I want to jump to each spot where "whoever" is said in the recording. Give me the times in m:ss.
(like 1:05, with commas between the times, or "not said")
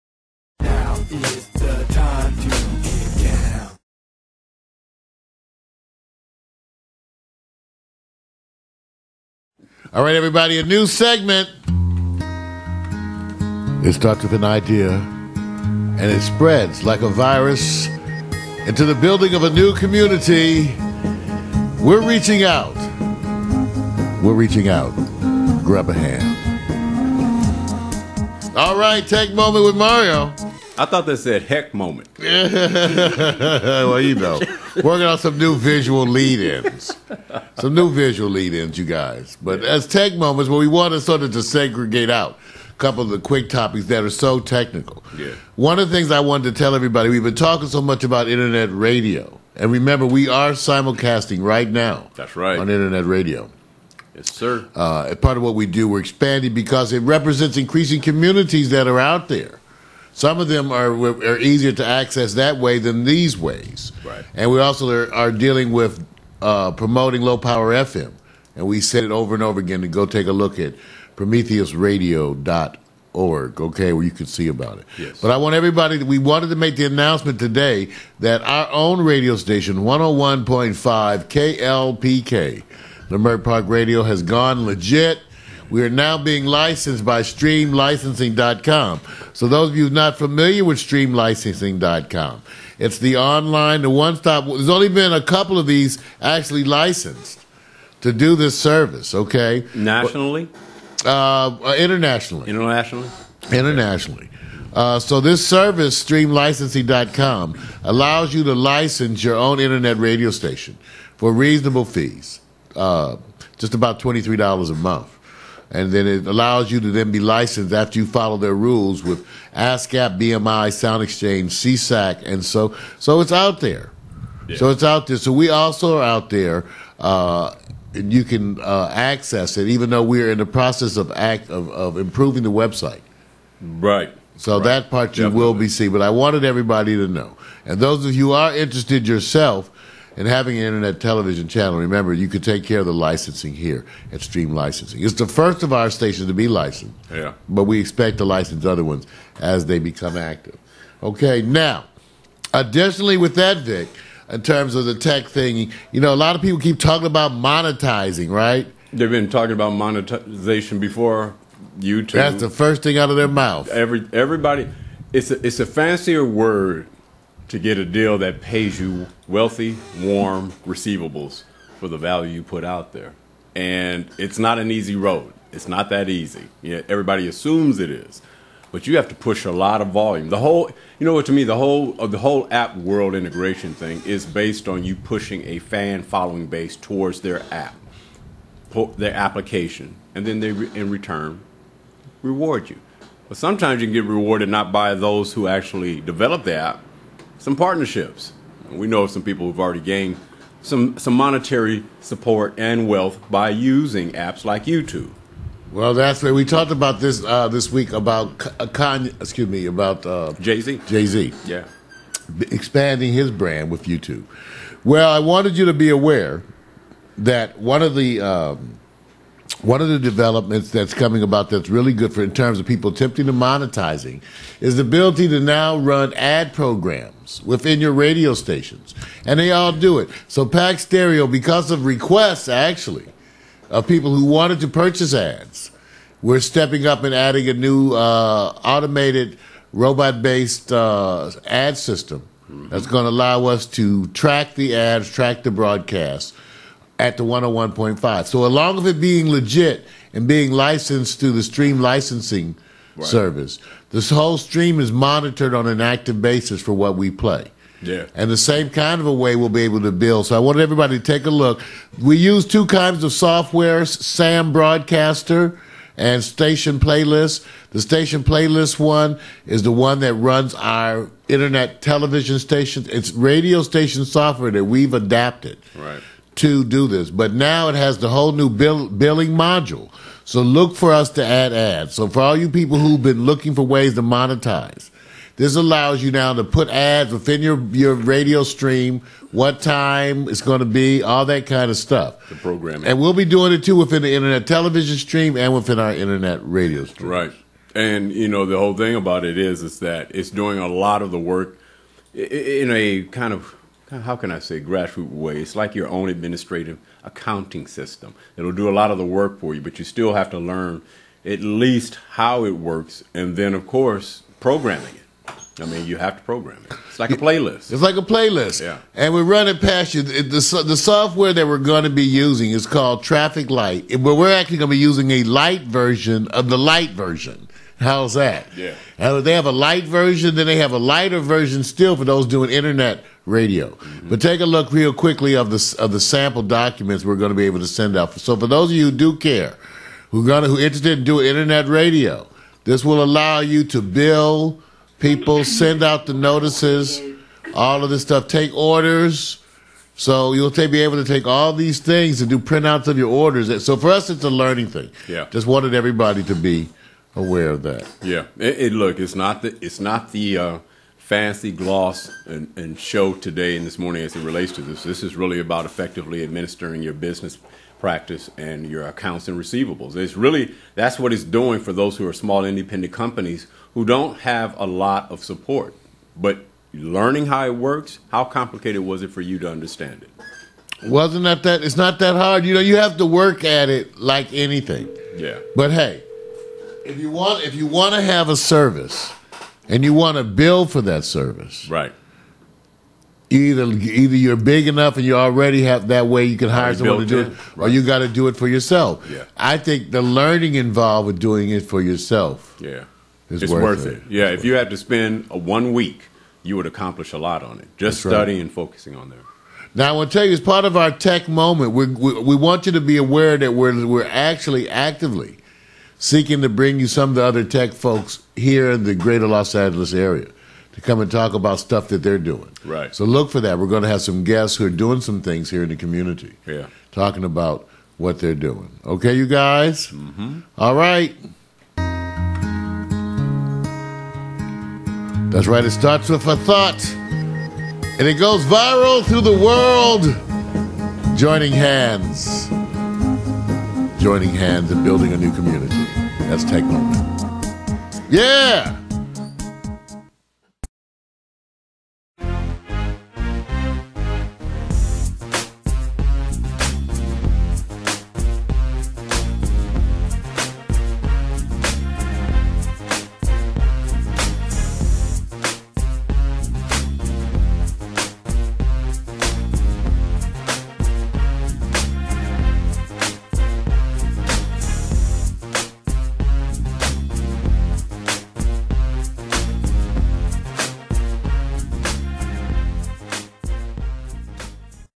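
not said.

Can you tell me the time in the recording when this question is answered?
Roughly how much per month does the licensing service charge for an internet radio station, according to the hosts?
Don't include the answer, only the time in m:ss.
1:53.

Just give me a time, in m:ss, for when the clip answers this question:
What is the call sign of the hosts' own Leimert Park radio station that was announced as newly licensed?
1:22.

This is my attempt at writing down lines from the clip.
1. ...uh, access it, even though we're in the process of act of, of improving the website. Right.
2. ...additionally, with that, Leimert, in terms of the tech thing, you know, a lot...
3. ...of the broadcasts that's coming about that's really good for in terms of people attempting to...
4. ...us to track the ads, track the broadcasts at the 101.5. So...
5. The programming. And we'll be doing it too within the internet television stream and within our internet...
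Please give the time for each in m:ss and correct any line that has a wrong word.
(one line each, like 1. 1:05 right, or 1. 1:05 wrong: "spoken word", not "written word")
1. 2:08 right
2. 2:32 wrong: "Vic", not "Leimert"
3. 3:39 wrong: "developments", not "broadcasts"
4. 4:03 right
5. 4:52 right.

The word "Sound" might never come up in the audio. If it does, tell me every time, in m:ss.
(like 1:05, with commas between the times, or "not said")
2:00.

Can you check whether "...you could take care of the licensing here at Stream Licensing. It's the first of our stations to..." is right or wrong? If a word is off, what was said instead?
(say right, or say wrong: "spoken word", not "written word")
right.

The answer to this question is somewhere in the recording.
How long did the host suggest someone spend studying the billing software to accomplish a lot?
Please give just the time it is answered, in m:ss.
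6:45.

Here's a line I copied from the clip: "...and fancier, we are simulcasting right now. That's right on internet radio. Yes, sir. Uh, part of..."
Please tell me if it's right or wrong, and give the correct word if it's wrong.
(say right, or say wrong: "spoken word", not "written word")
wrong: "remember", not "fancier".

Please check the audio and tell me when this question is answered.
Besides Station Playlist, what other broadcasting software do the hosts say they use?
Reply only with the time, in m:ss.
4:23.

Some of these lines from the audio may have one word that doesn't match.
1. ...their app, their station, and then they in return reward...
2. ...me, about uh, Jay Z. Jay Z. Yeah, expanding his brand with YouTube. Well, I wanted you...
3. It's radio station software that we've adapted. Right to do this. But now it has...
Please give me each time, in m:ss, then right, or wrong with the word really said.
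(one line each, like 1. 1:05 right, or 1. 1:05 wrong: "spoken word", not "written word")
1. 3:07 wrong: "application", not "station"
2. 3:29 right
3. 4:32 right.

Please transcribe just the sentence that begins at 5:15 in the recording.
I mean, you have to program it.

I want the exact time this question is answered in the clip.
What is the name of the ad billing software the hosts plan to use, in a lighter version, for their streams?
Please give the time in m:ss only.
5:23.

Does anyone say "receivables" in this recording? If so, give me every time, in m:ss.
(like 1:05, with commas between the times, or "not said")
2:50, 6:09.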